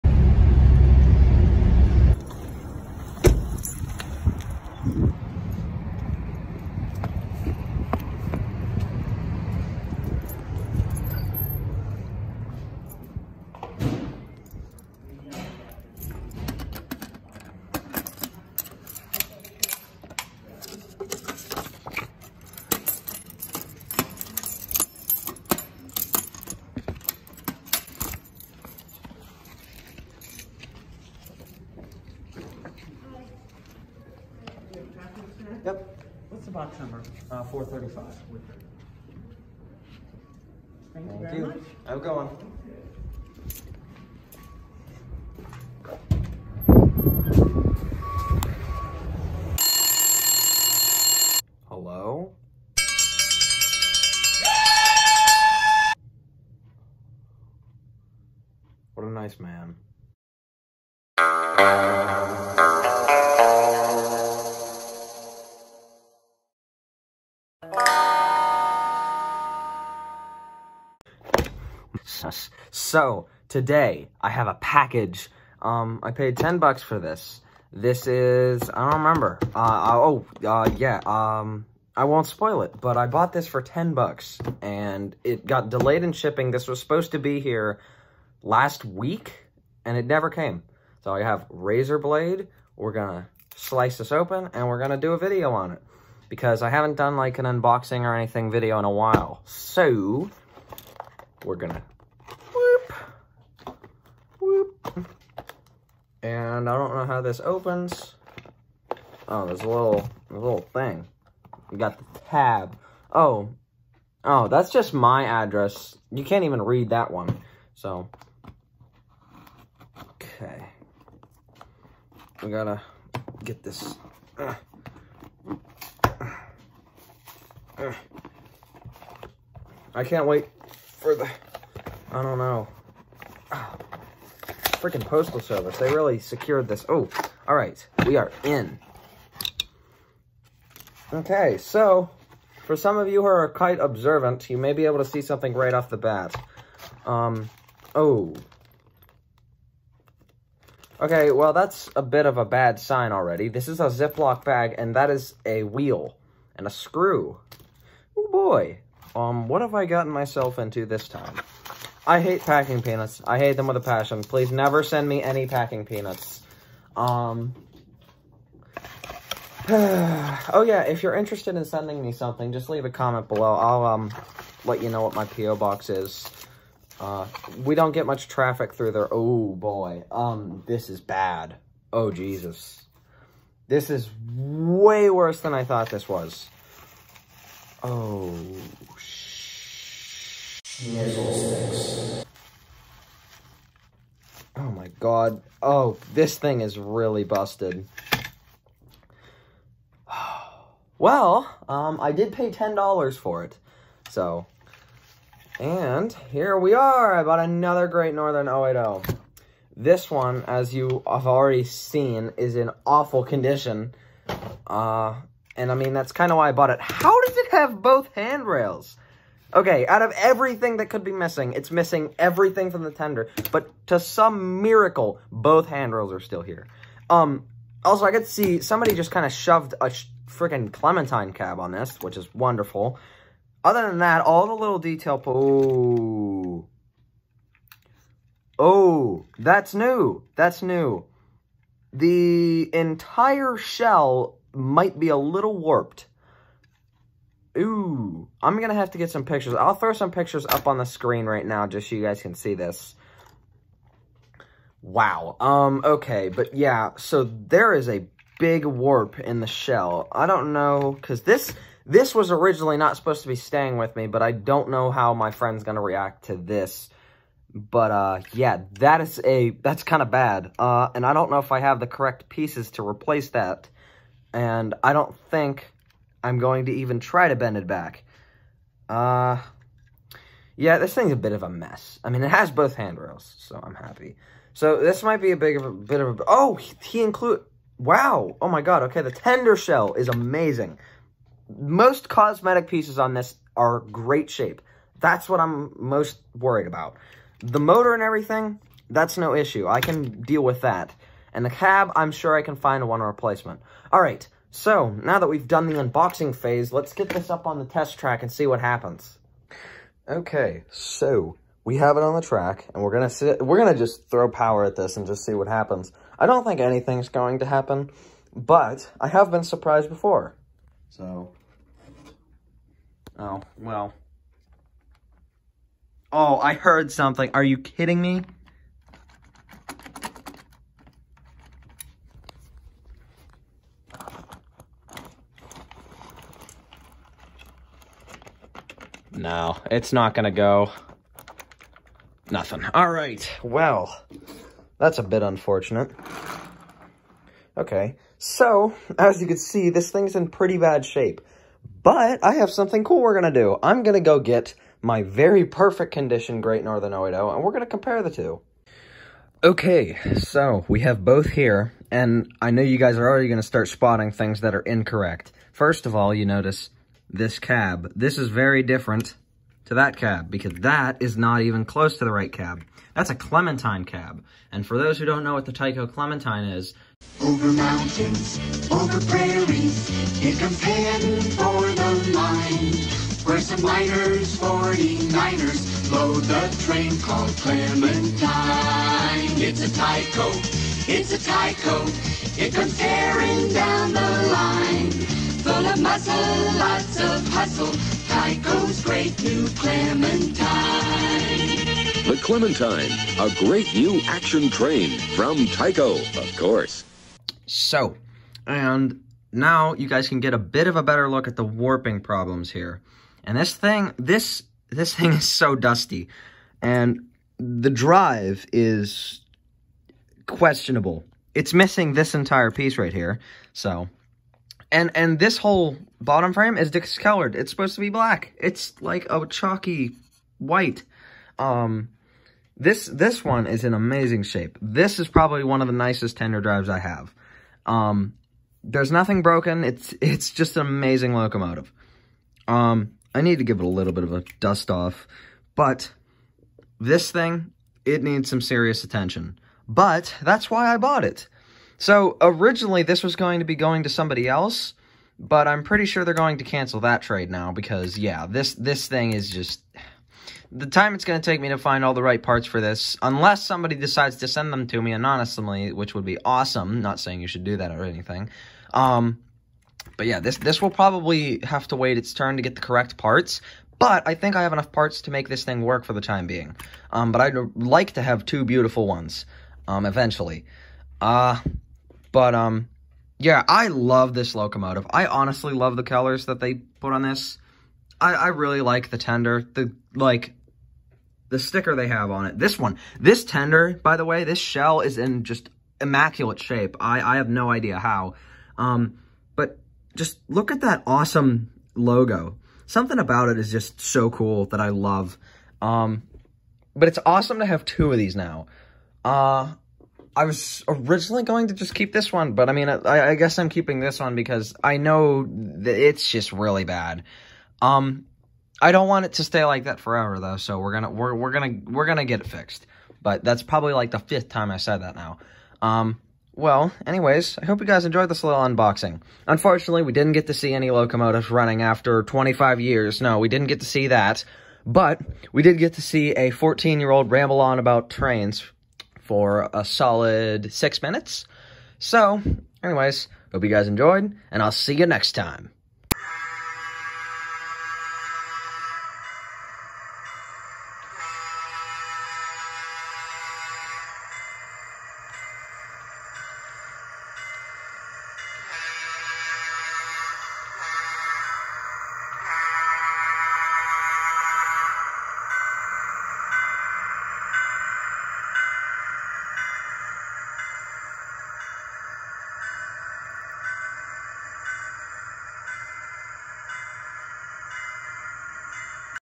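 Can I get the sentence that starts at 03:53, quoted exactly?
Other than that, all the little detail...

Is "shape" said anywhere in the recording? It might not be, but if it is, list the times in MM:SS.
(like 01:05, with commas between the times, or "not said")
04:54, 05:50, 07:14, 08:16.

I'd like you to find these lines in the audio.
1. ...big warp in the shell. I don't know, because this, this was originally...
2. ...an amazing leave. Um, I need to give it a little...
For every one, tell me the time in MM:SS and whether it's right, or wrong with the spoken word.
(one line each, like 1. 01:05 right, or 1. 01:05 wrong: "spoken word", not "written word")
1. 04:18 right
2. 07:20 wrong: "locomotive", not "leave".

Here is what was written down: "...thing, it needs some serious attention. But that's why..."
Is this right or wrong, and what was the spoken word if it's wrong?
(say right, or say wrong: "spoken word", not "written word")
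right.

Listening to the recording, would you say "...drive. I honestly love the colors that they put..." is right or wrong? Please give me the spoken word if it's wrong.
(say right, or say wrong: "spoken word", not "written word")
wrong: "locomotive", not "drive".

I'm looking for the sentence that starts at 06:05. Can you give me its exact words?
First of all, you notice this cab.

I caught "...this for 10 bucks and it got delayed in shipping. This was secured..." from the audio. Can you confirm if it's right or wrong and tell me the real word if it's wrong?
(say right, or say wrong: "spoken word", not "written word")
wrong: "supposed", not "secured".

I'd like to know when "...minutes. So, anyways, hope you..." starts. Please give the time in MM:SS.
09:00.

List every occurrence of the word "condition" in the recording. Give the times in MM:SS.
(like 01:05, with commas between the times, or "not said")
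03:33, 05:55.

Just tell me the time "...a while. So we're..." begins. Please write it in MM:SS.
01:38.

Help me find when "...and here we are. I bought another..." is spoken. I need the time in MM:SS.
03:25.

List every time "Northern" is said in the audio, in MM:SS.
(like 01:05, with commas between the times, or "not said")
03:28, 05:56.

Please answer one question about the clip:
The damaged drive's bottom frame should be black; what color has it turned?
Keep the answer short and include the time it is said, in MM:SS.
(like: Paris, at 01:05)
Chalky white, at 07:09.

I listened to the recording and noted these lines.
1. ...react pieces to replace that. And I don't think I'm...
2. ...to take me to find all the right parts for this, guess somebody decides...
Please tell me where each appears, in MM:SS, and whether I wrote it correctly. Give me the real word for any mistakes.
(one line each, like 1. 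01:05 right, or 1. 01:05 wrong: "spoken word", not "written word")
1. 04:31 wrong: "correct", not "react"
2. 07:41 wrong: "unless", not "guess".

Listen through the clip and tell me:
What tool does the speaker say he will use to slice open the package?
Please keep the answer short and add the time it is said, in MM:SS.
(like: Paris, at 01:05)
Razor blade, at 01:31.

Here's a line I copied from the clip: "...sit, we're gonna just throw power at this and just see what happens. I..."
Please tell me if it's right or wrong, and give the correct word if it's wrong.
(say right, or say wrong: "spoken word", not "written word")
right.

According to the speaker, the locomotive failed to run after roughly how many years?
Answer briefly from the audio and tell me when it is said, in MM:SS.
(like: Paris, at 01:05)
25 years, at 08:52.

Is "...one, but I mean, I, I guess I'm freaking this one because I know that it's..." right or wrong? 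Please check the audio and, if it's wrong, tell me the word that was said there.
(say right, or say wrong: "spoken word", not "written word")
wrong: "keeping", not "freaking".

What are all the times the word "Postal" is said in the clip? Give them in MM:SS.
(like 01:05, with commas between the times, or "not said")
02:15.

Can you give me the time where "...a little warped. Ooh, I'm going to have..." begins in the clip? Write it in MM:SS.
04:05.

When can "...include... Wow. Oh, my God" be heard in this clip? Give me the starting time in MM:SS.
04:47.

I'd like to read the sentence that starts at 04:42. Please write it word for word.
I mean, it has both handrails, so I'm happy.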